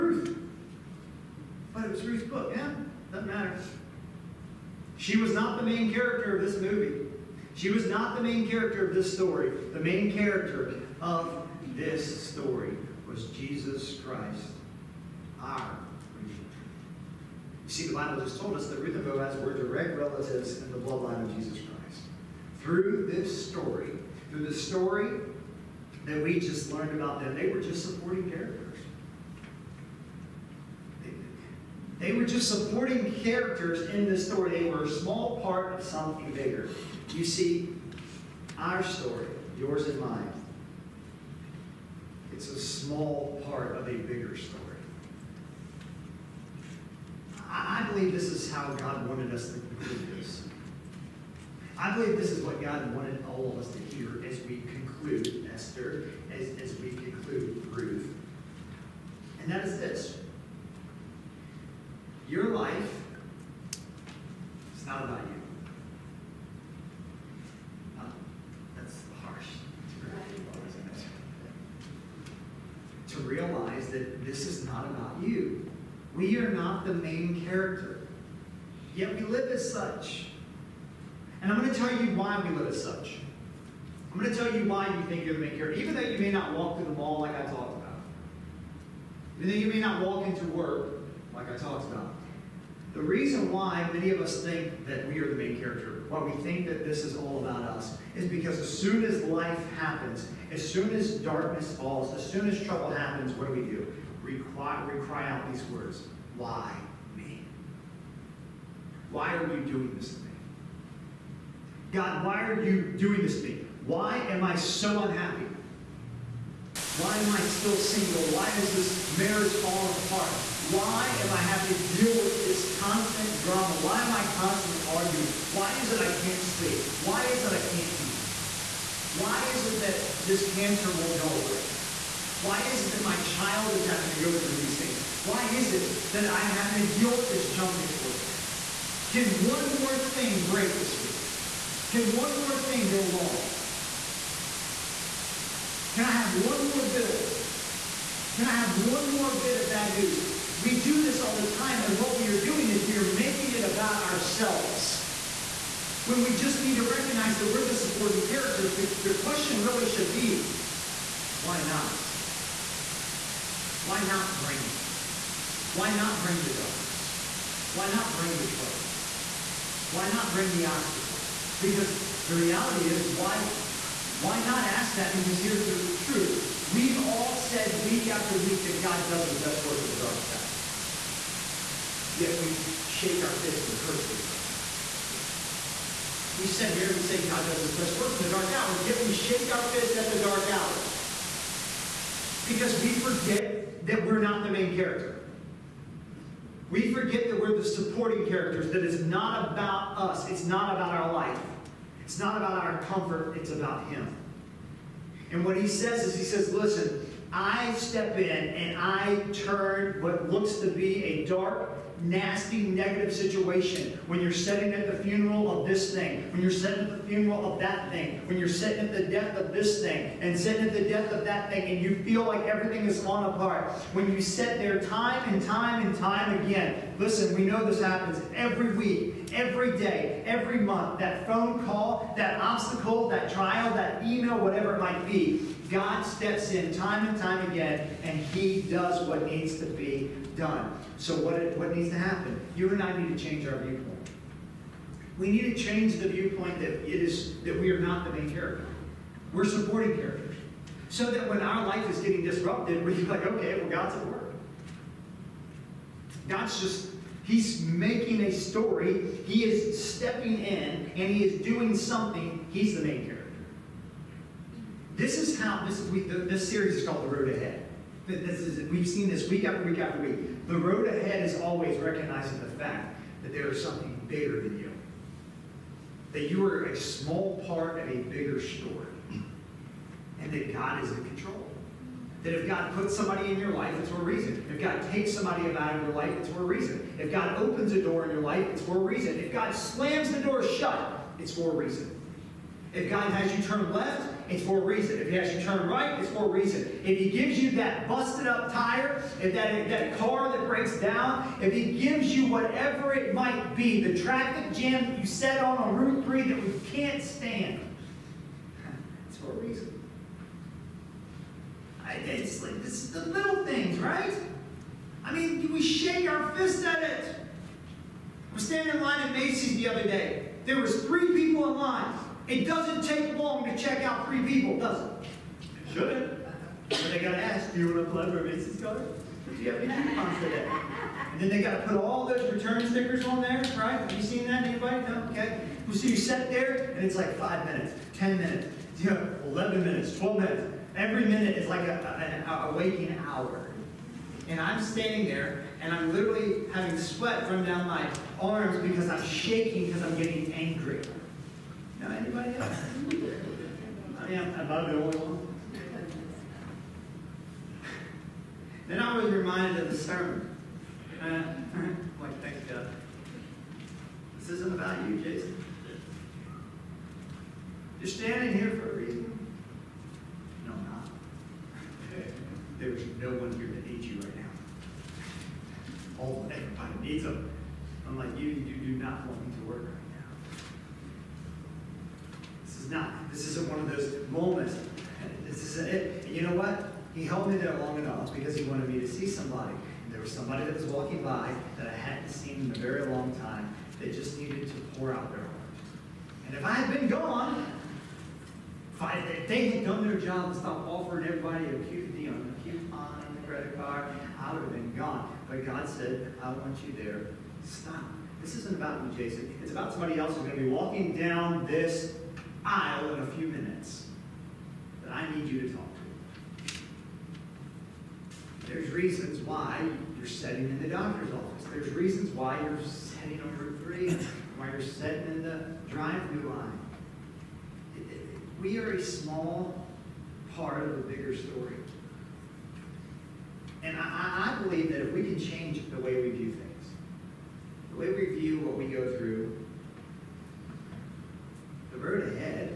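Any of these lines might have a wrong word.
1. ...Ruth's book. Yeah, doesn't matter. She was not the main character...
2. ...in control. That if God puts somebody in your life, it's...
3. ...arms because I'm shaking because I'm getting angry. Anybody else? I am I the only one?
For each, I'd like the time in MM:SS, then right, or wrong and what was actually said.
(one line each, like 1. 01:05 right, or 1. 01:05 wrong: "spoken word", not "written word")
1. 00:02 right
2. 04:40 right
3. 05:48 right.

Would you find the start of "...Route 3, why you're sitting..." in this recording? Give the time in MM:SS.
07:03.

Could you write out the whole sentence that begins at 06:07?
You're standing here for a reason.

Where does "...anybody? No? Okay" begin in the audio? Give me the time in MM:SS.
05:34.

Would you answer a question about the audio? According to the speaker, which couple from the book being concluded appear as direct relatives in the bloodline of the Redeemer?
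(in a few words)
Ruth and Boaz.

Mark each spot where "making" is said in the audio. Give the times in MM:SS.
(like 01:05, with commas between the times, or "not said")
02:33, 04:17.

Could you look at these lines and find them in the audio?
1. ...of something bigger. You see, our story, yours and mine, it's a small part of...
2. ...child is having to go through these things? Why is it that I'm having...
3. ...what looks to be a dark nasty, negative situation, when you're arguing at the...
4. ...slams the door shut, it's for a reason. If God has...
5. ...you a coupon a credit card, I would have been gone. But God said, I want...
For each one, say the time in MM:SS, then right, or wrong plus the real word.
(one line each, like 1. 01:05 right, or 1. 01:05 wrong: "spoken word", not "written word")
1. 00:35 right
2. 02:13 right
3. 03:30 wrong: "sitting", not "arguing"
4. 04:49 right
5. 06:42 right.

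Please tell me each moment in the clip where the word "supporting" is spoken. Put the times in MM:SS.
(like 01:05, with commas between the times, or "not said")
00:27, 00:32, 02:37, 03:17, 04:09.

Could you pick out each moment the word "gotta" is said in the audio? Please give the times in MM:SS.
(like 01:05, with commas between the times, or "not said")
05:27, 05:31.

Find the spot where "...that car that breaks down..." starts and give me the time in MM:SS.
04:59.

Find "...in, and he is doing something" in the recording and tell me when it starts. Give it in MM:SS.
04:20.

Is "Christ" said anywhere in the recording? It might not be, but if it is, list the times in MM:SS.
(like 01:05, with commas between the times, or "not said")
00:14, 00:21.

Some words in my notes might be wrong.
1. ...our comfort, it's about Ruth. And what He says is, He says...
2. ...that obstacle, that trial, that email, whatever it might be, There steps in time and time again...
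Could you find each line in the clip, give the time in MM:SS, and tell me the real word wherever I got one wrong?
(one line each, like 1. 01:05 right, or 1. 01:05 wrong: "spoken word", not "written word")
1. 03:22 wrong: "Him", not "Ruth"
2. 03:52 wrong: "God", not "There".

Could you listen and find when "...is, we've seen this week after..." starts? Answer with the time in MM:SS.
04:28.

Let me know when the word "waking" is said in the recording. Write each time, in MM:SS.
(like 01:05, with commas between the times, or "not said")
05:42.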